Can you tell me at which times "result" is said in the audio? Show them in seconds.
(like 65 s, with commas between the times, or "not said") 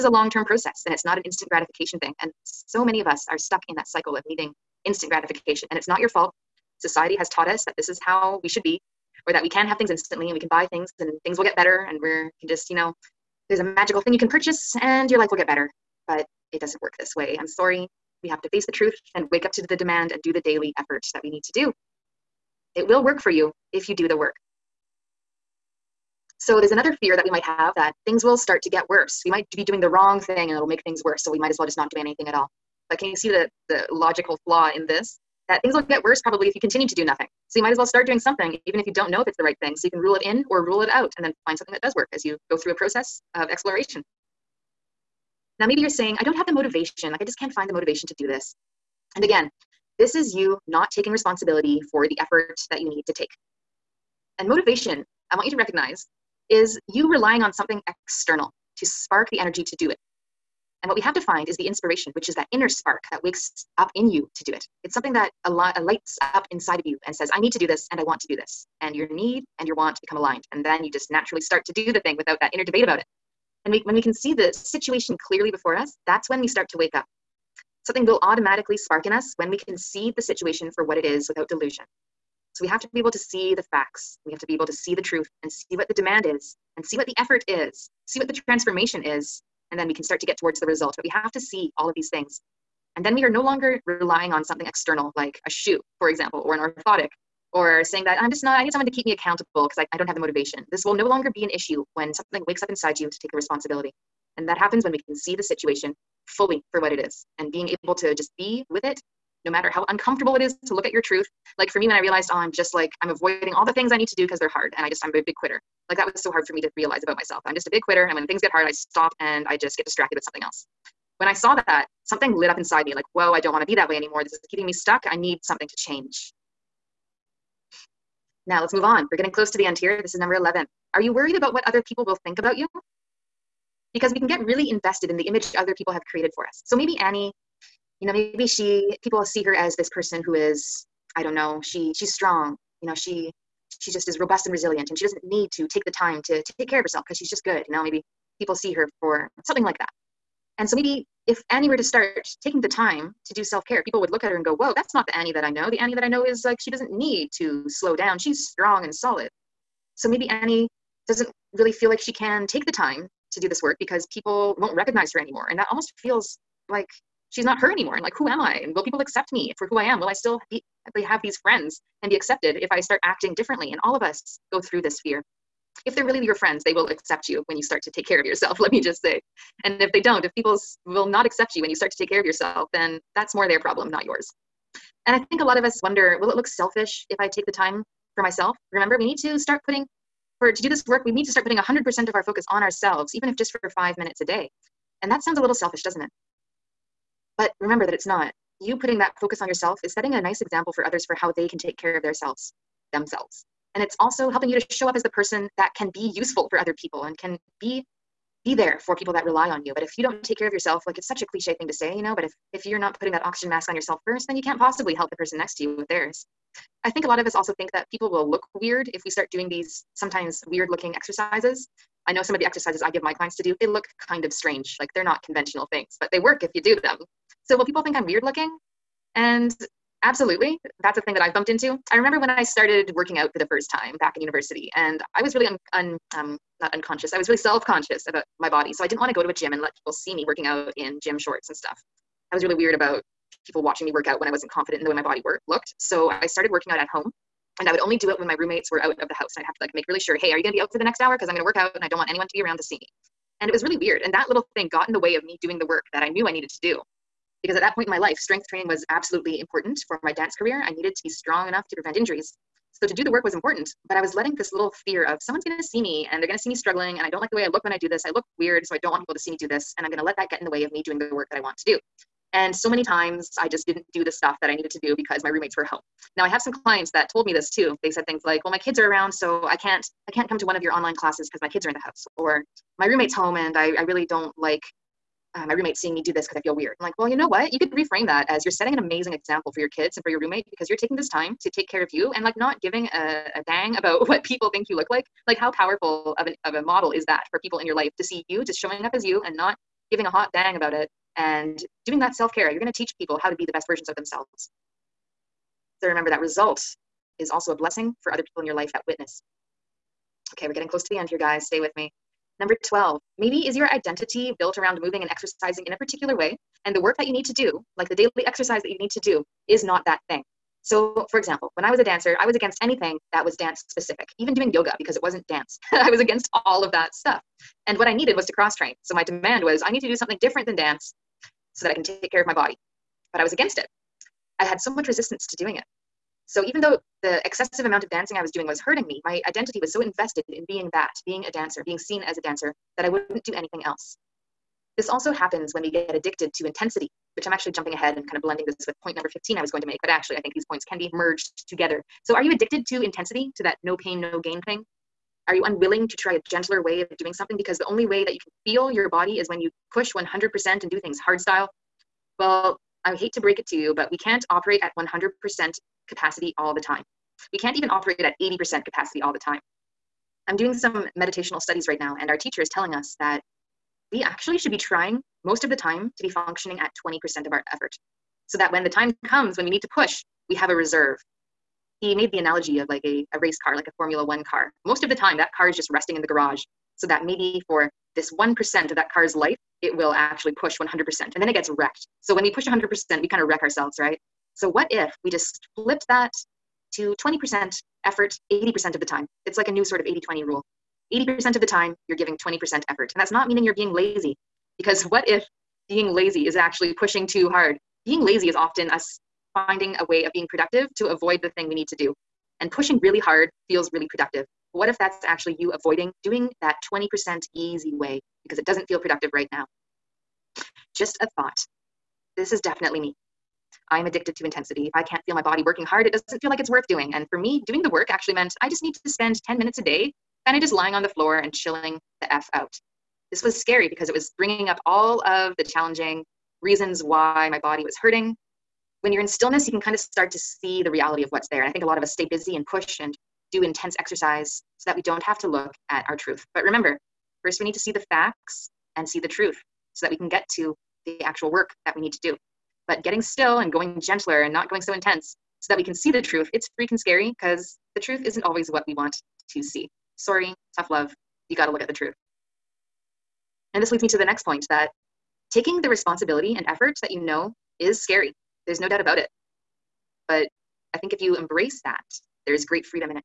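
90 s, 306 s.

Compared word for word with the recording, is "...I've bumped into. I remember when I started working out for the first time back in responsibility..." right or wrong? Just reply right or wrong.
wrong.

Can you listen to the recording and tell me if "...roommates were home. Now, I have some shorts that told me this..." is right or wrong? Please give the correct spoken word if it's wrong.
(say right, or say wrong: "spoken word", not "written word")
wrong: "clients", not "shorts".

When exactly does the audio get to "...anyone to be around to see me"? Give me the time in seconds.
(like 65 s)
252 s.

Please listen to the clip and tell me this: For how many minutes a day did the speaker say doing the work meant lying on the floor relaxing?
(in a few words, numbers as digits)
10.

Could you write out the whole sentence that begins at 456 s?
It's freaking scary because the truth isn't always what we want to see.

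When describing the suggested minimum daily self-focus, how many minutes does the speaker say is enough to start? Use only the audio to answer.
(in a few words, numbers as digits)
5 minutes.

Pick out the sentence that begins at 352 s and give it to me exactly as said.
So are you addicted to intensity, to that no pain, no gain thing?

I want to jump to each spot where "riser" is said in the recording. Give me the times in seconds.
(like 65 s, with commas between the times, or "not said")
not said.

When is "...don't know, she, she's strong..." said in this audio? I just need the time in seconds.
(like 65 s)
141 s.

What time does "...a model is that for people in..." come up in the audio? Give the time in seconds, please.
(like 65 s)
296 s.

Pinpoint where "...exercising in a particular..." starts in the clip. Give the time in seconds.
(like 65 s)
315 s.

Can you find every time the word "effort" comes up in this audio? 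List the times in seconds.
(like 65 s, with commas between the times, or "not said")
20 s, 52 s, 87 s, 377 s, 397 s, 402 s, 466 s.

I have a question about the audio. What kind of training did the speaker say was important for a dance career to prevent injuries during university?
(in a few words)
strength training.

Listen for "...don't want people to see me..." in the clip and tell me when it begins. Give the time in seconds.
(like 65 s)
268 s.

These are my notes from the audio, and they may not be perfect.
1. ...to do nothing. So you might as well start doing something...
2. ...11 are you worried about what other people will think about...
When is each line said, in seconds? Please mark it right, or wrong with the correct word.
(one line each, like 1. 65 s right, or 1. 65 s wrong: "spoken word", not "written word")
1. 36 s right
2. 130 s right.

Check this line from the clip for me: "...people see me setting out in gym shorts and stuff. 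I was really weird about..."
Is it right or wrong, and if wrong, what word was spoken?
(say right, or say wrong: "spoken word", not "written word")
wrong: "working", not "setting".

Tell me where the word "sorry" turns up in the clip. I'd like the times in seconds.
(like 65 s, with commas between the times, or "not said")
17 s, 459 s.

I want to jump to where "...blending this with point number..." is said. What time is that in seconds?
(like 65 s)
348 s.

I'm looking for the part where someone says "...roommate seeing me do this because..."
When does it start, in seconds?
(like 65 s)
285 s.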